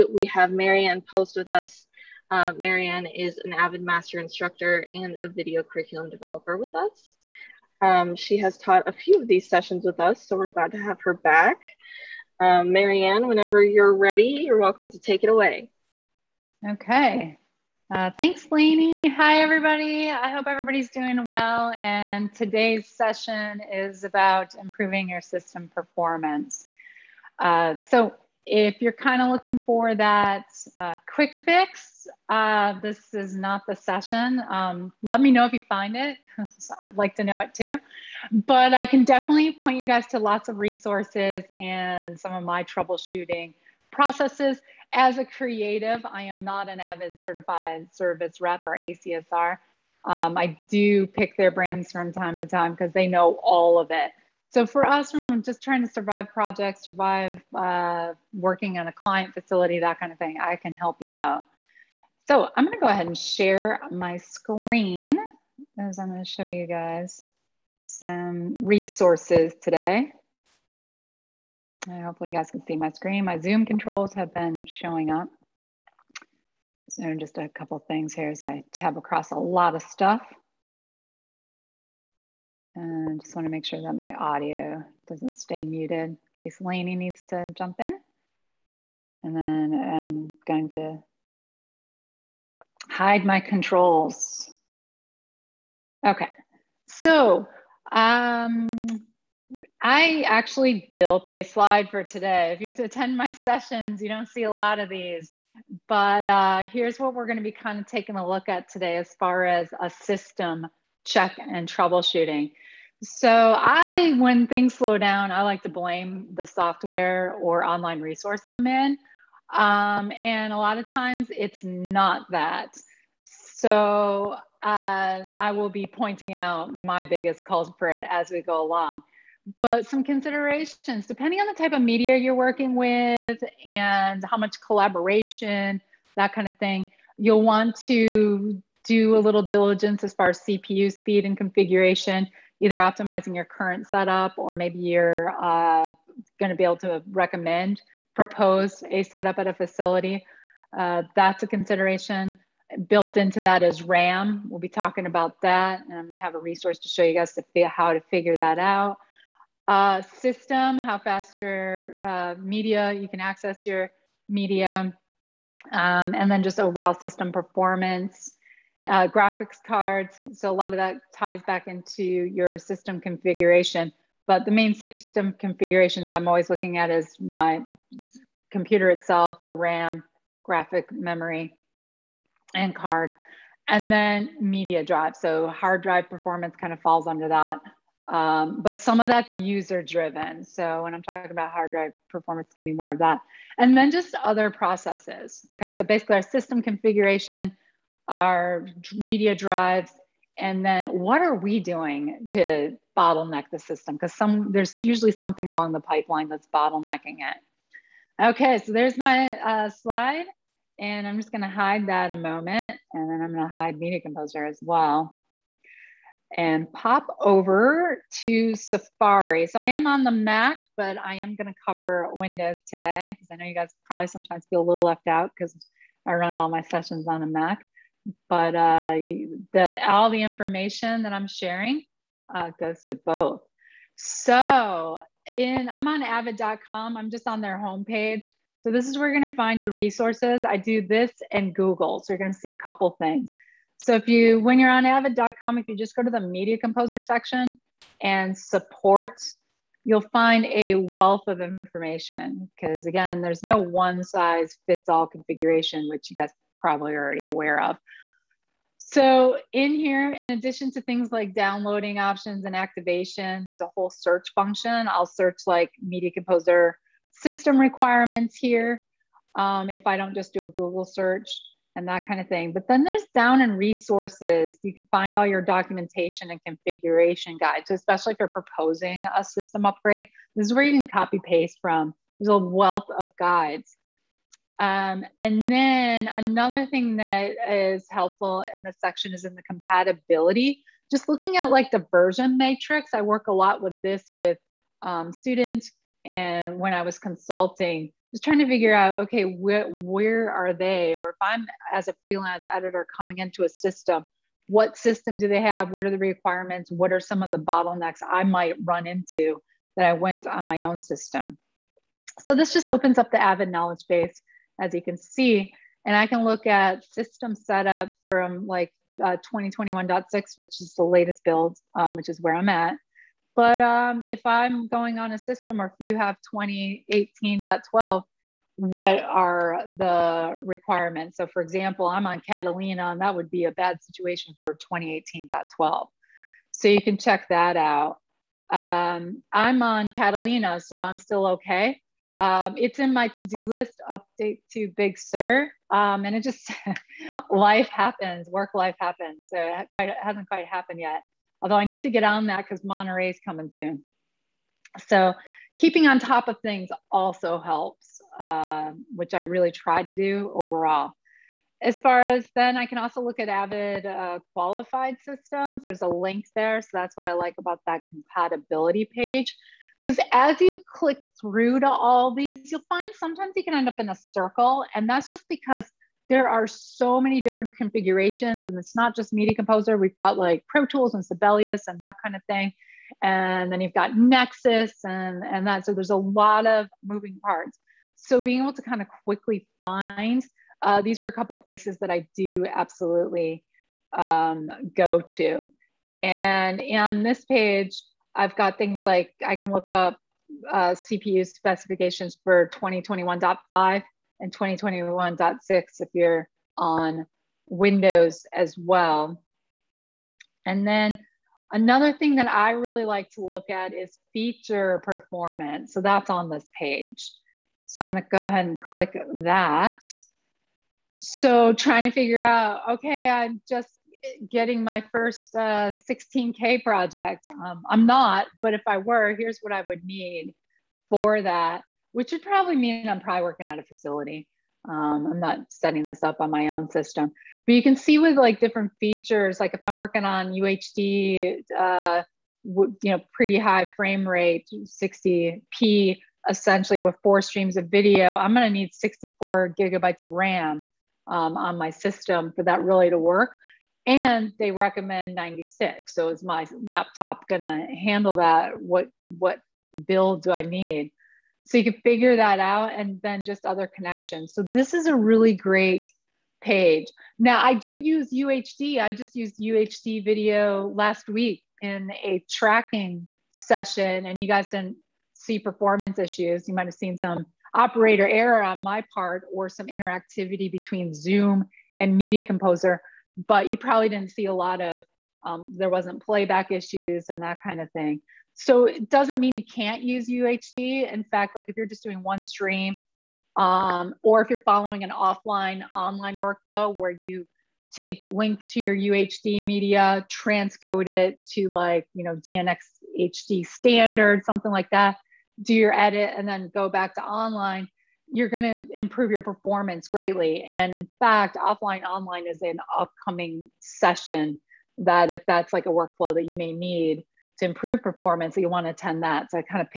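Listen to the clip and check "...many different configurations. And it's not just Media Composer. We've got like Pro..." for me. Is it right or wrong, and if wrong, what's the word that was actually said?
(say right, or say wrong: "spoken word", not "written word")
right.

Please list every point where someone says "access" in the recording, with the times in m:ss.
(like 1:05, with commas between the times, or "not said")
2:43.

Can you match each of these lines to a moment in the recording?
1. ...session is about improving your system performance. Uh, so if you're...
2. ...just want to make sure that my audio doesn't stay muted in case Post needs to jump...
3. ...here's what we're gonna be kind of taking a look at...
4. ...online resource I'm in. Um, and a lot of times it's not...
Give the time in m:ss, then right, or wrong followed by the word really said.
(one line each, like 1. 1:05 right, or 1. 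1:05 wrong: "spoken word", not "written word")
1. 0:22 right
2. 1:23 wrong: "Lainey", not "Post"
3. 1:46 right
4. 1:57 right.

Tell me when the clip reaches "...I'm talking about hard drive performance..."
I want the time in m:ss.
3:10.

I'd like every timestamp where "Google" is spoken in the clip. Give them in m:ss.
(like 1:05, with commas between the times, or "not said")
4:01, 4:30.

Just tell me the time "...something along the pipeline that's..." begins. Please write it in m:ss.
3:25.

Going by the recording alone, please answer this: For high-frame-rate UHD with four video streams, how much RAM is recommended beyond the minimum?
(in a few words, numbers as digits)
96.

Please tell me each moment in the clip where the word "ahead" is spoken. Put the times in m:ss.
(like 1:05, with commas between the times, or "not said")
1:02, 6:58.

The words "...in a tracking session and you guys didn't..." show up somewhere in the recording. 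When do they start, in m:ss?
7:51.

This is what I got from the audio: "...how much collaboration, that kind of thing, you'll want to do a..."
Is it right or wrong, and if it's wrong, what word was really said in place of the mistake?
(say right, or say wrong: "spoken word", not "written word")
right.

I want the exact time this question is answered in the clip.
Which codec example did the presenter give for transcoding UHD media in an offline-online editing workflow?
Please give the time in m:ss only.
8:22.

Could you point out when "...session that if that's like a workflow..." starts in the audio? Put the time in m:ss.
8:33.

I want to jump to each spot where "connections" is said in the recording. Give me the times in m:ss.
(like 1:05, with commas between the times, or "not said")
7:43.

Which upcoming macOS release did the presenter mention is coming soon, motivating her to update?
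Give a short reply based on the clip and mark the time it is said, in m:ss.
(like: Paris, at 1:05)
Monterey, at 5:52.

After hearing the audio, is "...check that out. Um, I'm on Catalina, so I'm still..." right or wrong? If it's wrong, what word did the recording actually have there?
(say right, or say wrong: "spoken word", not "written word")
right.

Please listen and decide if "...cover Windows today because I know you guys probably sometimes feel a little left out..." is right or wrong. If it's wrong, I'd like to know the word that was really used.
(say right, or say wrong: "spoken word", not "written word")
right.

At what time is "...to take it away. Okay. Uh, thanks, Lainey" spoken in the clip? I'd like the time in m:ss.
0:14.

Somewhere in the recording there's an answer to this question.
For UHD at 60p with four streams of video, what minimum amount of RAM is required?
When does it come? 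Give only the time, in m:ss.
7:28.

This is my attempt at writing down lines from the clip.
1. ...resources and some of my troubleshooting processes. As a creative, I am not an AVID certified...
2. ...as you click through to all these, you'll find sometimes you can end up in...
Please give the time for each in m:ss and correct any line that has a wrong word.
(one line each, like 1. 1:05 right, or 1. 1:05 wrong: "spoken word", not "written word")
1. 0:40 right
2. 6:10 right.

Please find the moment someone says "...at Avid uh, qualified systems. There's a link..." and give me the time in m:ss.
6:03.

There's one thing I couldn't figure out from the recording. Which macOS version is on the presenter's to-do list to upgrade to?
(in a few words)
Big Sur.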